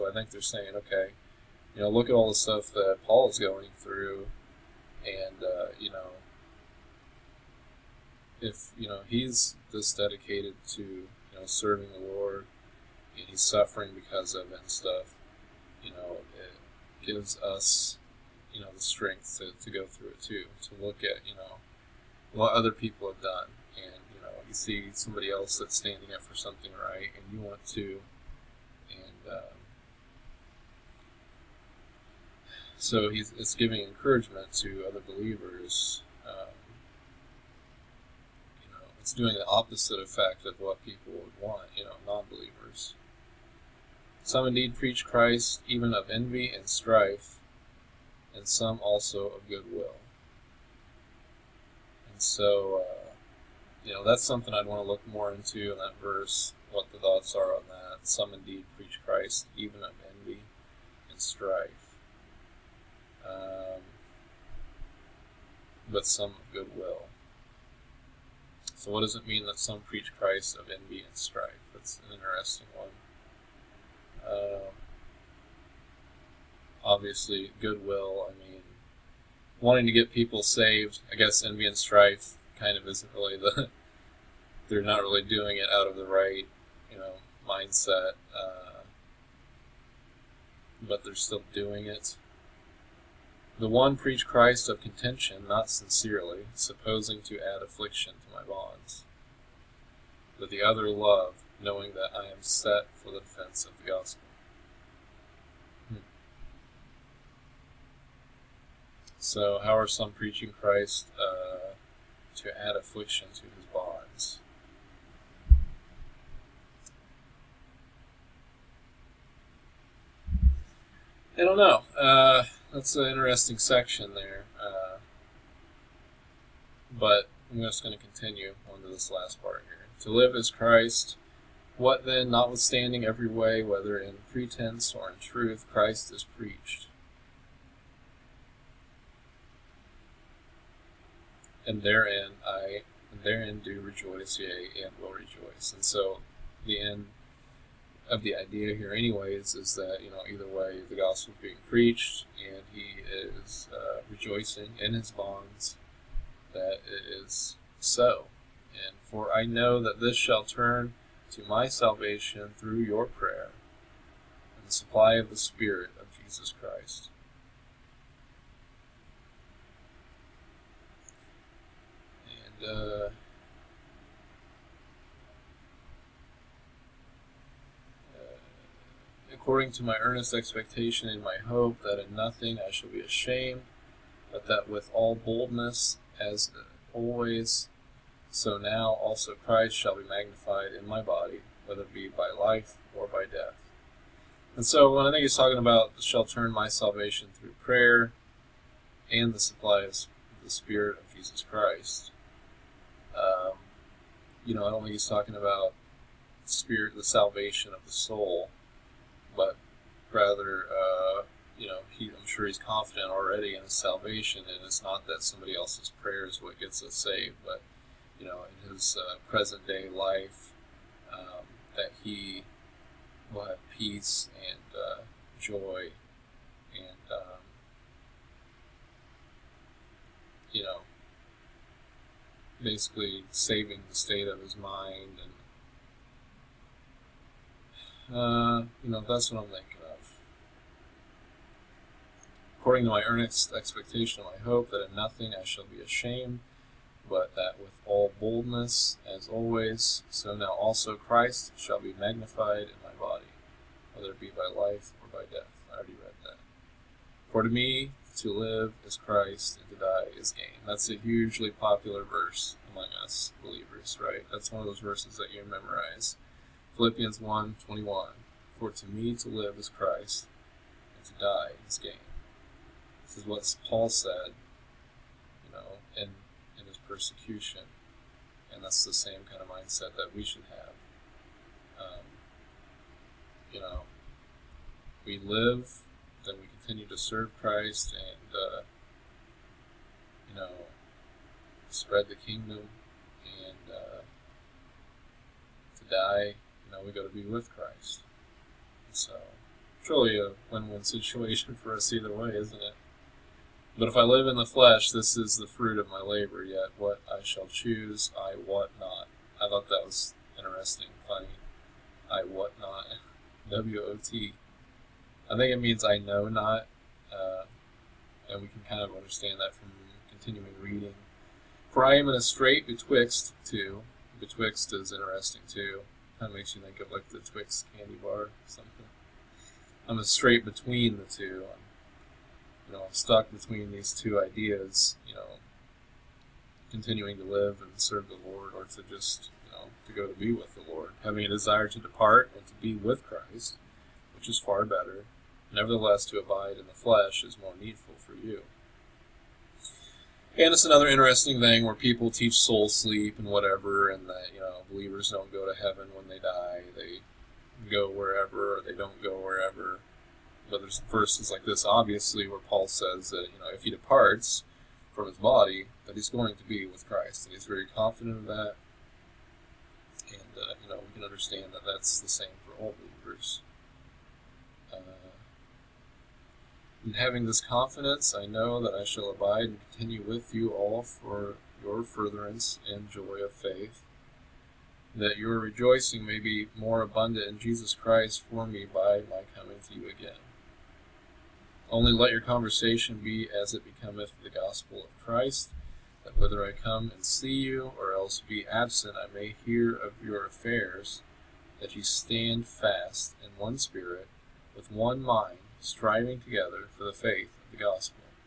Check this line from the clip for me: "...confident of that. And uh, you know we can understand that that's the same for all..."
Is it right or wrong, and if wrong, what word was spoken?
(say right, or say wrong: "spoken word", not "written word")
right.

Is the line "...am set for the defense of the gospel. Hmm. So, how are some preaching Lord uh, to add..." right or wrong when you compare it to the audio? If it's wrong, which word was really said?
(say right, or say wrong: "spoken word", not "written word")
wrong: "Christ", not "Lord".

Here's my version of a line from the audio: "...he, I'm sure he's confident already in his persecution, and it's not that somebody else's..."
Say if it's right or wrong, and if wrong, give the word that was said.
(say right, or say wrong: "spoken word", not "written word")
wrong: "salvation", not "persecution".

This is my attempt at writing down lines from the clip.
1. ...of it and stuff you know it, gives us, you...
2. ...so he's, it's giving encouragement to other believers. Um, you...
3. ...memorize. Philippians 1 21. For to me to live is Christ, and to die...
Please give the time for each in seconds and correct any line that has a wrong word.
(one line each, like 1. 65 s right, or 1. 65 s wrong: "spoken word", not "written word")
1. 14 s right
2. 32 s right
3. 265 s right.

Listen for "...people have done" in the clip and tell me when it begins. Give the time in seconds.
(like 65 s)
22 s.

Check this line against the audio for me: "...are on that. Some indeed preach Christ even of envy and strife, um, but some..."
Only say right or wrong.
right.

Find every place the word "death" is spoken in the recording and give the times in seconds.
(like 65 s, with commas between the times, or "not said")
193 s, 255 s.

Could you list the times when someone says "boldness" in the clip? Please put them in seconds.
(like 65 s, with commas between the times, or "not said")
185 s, 248 s.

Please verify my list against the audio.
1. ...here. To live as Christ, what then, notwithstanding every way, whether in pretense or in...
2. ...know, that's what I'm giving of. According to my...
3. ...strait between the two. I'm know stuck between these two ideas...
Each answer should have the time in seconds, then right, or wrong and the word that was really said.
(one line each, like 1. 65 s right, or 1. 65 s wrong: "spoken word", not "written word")
1. 129 s right
2. 238 s wrong: "thinking", not "giving"
3. 330 s right.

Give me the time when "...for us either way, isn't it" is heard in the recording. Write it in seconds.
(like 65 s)
301 s.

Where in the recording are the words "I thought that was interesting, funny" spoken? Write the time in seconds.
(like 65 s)
309 s.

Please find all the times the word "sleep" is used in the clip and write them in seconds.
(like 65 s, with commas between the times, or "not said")
352 s.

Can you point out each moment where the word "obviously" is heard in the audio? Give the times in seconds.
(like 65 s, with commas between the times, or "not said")
76 s, 361 s.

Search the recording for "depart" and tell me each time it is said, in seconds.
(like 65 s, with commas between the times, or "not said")
341 s, 363 s.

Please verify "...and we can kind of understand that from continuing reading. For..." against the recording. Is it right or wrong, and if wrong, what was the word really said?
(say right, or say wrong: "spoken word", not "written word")
right.